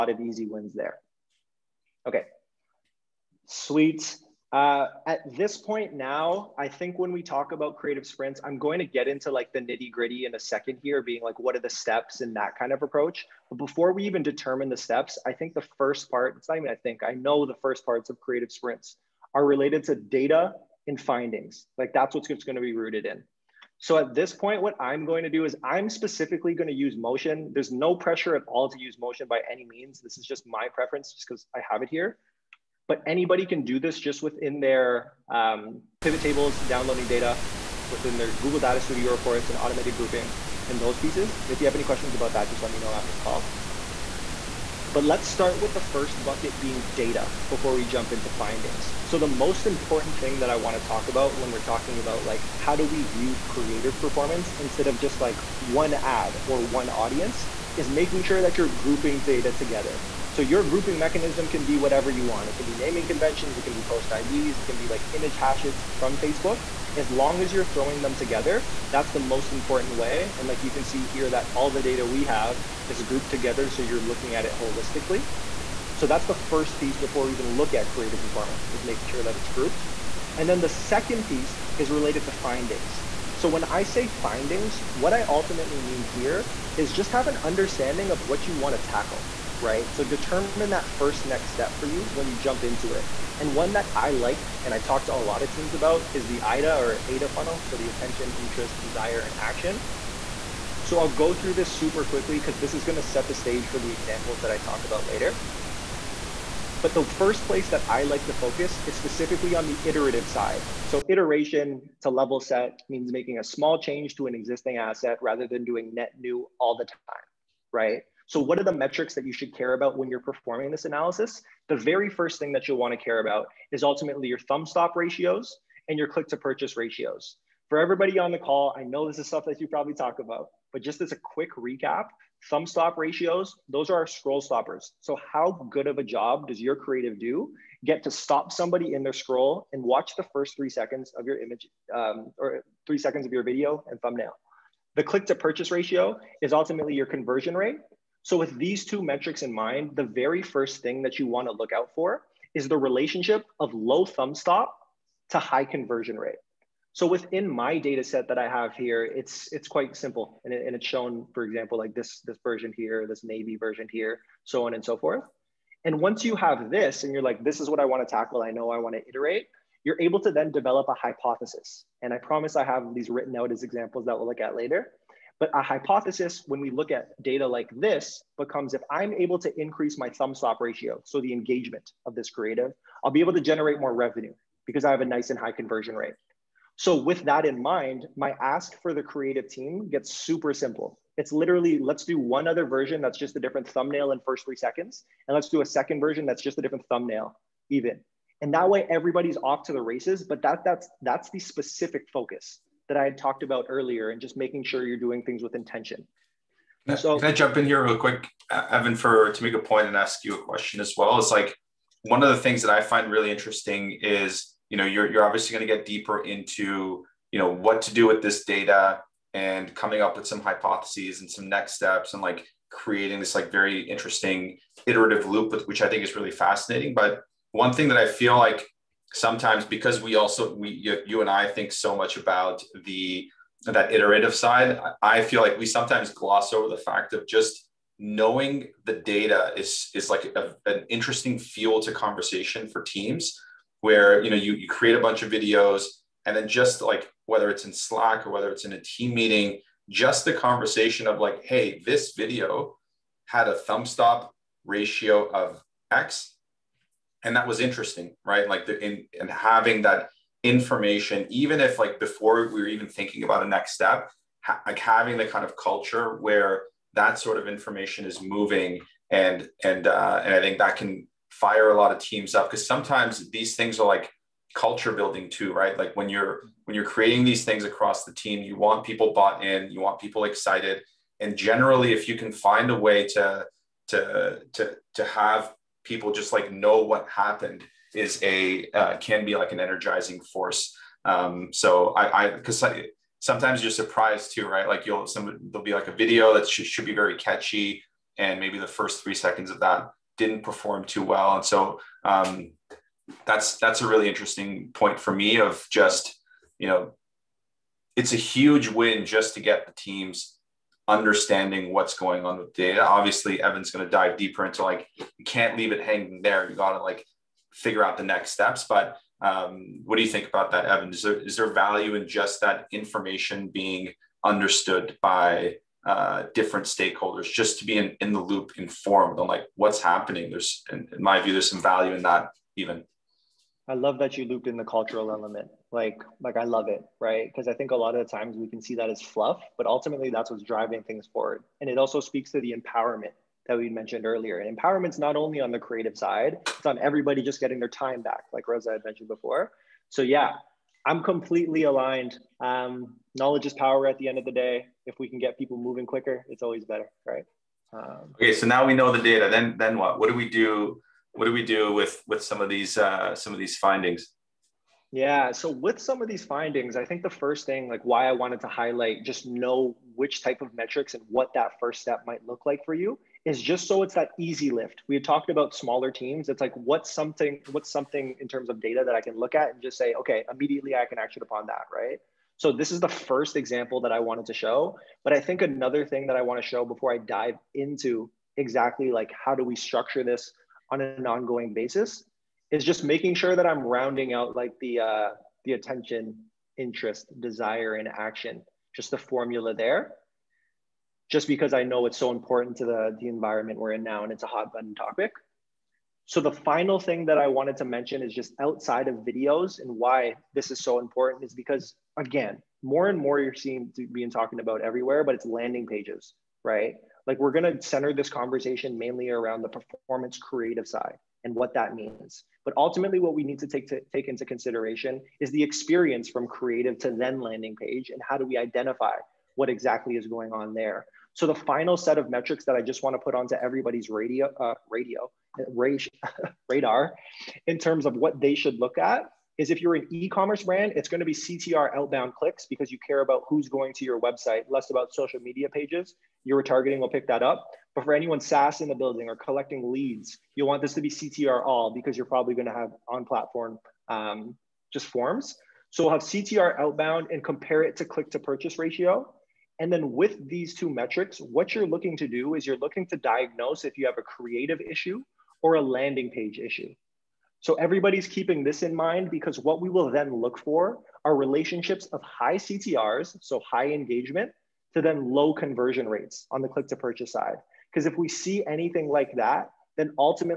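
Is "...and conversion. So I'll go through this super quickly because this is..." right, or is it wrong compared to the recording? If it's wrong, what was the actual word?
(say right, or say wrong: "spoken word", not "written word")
wrong: "action", not "conversion".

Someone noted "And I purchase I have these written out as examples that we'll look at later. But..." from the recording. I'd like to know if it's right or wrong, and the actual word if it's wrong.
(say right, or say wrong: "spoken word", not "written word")
wrong: "promise", not "purchase".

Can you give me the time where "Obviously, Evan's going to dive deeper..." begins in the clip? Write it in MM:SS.
05:12.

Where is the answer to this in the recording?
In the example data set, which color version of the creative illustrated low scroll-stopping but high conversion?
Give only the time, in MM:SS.
02:43.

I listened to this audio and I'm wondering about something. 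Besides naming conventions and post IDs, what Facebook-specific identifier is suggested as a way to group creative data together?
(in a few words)
Image hashes.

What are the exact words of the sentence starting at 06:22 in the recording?
So this is the first example that I wanted to show.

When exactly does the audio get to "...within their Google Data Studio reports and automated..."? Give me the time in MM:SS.
00:37.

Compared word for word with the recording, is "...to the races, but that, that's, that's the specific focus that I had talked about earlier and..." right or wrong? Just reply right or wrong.
right.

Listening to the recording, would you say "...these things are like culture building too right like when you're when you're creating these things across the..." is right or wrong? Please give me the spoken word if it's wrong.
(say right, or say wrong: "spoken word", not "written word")
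right.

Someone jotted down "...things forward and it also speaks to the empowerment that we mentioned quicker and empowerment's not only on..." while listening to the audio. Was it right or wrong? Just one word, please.
wrong.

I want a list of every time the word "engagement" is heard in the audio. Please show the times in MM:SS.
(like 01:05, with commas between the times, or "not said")
03:01, 07:53.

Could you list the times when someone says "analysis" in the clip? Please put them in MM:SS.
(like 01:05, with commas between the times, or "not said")
02:00.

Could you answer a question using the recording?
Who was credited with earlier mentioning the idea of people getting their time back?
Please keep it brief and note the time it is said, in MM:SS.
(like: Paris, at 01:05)
Reza, at 05:48.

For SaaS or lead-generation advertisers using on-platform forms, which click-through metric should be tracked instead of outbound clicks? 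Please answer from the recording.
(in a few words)
CTR all.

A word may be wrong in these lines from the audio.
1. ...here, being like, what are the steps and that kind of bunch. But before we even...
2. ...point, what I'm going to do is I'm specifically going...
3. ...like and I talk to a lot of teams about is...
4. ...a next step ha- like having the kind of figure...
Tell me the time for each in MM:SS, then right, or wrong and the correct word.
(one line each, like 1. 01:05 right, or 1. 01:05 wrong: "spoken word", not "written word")
1. 00:10 wrong: "approach", not "bunch"
2. 00:24 right
3. 01:34 right
4. 04:23 wrong: "culture", not "figure".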